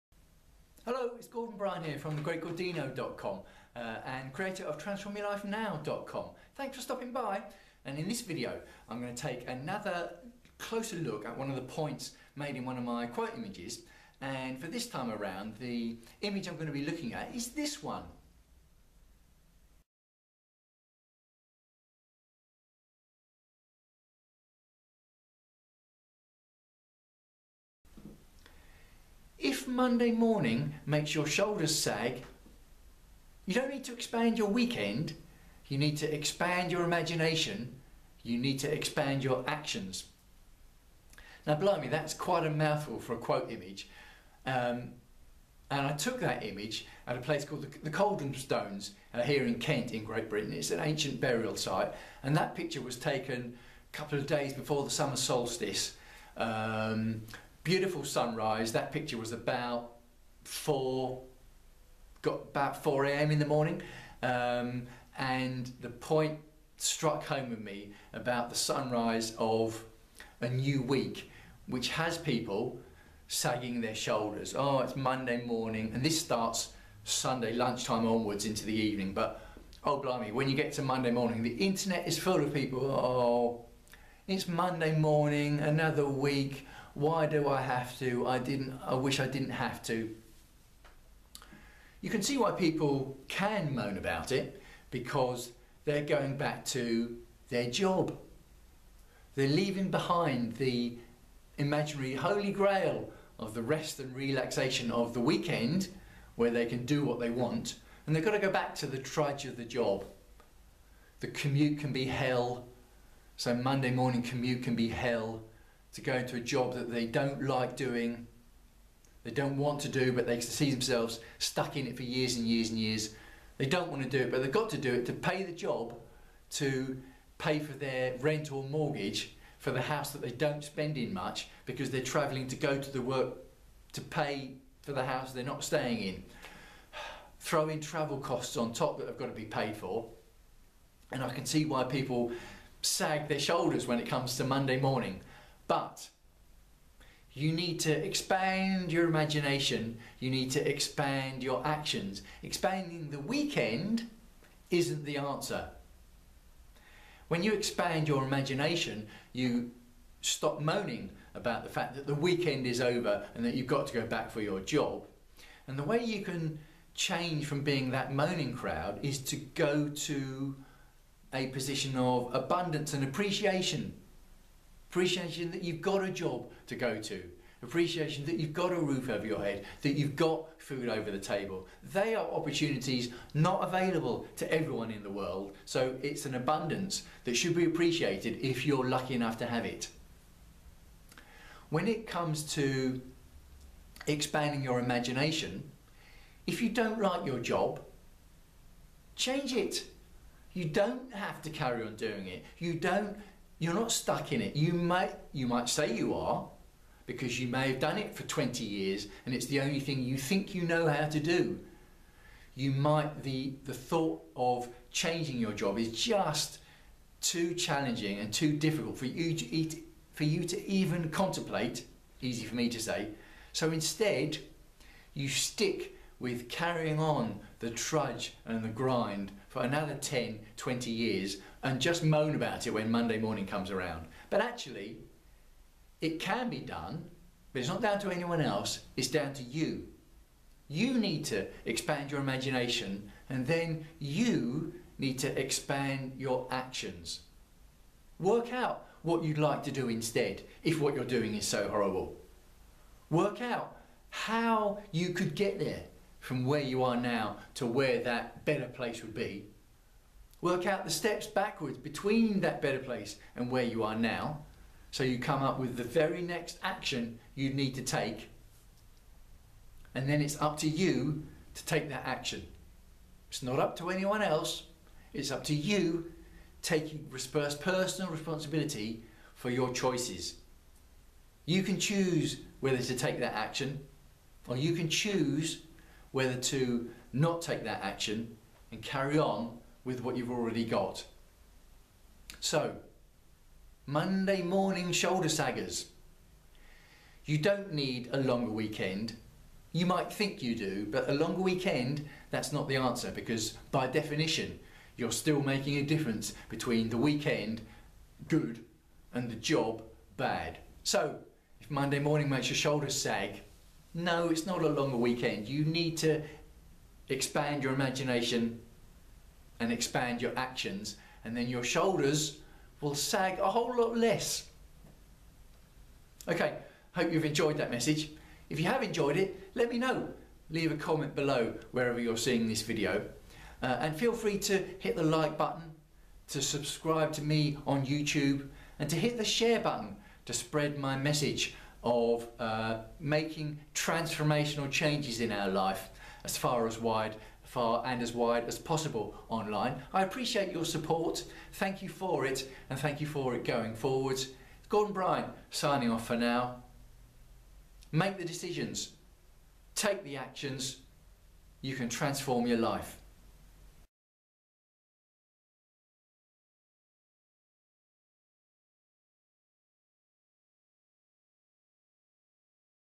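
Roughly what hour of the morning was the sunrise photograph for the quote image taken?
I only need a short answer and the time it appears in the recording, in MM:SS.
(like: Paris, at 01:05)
4 a.m., at 01:02.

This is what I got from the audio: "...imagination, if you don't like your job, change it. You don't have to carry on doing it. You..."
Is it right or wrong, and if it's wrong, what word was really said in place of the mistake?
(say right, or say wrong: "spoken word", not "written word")
right.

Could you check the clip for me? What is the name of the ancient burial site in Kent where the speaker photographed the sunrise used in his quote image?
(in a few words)
the Stones.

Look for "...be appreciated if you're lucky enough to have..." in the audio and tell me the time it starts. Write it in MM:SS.
03:07.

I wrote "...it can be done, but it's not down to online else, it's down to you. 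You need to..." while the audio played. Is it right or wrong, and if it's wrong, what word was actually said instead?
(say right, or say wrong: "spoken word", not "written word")
wrong: "anyone", not "online".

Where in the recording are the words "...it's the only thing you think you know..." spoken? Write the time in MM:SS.
03:29.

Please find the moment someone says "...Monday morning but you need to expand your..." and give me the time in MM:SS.
02:24.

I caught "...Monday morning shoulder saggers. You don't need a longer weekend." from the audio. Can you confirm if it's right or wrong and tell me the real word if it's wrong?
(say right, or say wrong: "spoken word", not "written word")
right.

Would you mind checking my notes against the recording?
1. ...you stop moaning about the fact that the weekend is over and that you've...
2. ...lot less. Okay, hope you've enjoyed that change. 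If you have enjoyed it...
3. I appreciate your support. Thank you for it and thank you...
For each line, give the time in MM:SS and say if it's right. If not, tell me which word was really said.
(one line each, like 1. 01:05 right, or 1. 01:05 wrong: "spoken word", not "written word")
1. 02:39 right
2. 05:23 wrong: "message", not "change"
3. 05:49 right.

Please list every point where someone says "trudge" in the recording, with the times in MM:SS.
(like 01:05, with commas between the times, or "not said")
01:48, 03:47.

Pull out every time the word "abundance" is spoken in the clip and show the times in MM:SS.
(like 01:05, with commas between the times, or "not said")
02:52, 03:06.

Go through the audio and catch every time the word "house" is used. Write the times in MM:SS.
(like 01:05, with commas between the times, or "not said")
02:09, 02:15.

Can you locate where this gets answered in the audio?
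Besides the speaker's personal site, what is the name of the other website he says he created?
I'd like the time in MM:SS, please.
00:04.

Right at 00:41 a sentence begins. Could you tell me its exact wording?
Now, blimey, that's quite a mouthful for a quote image.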